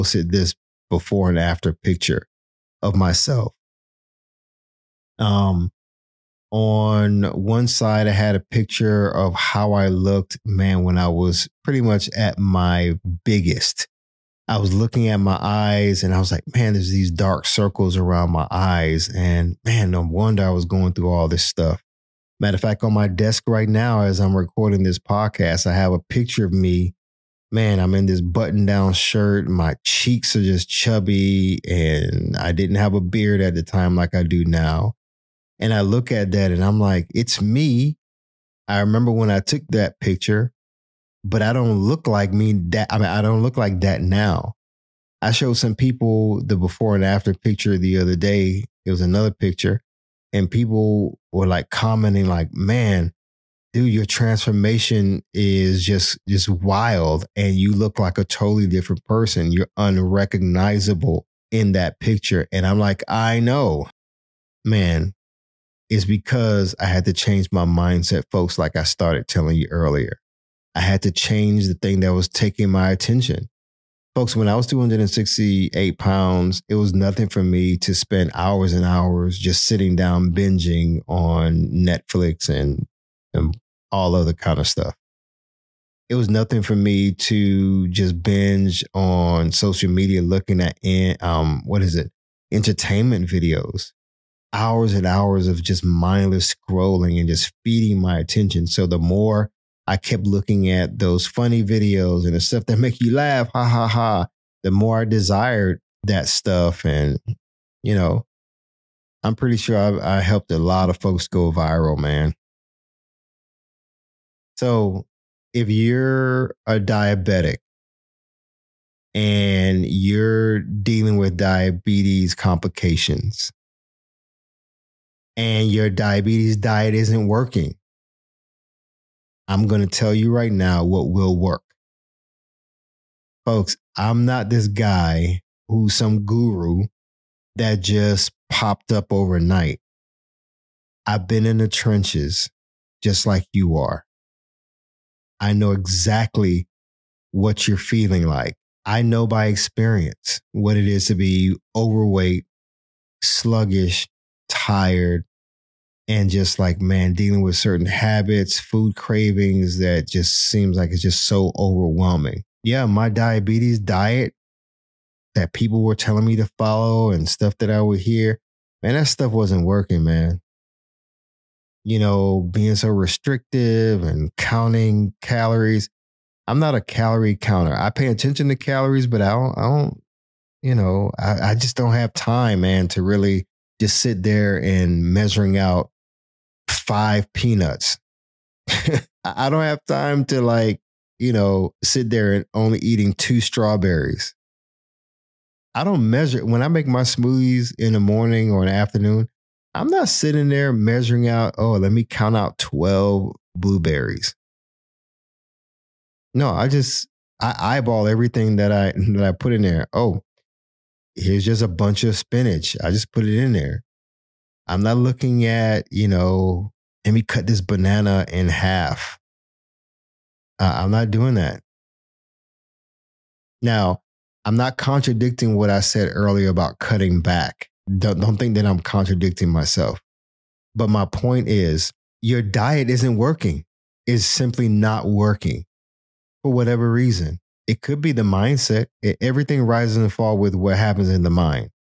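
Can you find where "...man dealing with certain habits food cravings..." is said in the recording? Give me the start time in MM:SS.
02:36.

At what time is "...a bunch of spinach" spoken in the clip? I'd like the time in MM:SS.
03:31.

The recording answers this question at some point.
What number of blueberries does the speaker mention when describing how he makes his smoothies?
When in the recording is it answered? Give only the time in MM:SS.
03:22.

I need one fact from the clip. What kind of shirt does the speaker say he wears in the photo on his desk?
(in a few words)
button down shirt.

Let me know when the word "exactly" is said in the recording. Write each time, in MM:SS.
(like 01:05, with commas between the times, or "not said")
02:25.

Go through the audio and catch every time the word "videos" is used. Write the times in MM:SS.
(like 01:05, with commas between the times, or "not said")
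01:33, 01:41.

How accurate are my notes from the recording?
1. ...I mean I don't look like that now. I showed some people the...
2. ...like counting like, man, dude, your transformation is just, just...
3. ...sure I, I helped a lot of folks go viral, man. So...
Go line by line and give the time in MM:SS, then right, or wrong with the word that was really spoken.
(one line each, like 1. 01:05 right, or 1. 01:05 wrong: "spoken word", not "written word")
1. 00:42 right
2. 00:51 wrong: "commenting", not "counting"
3. 01:49 right.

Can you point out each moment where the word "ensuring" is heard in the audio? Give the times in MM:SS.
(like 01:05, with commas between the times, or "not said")
not said.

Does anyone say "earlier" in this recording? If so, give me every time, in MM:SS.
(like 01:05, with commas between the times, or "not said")
01:09, 03:46.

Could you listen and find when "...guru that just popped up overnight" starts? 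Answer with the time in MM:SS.
02:16.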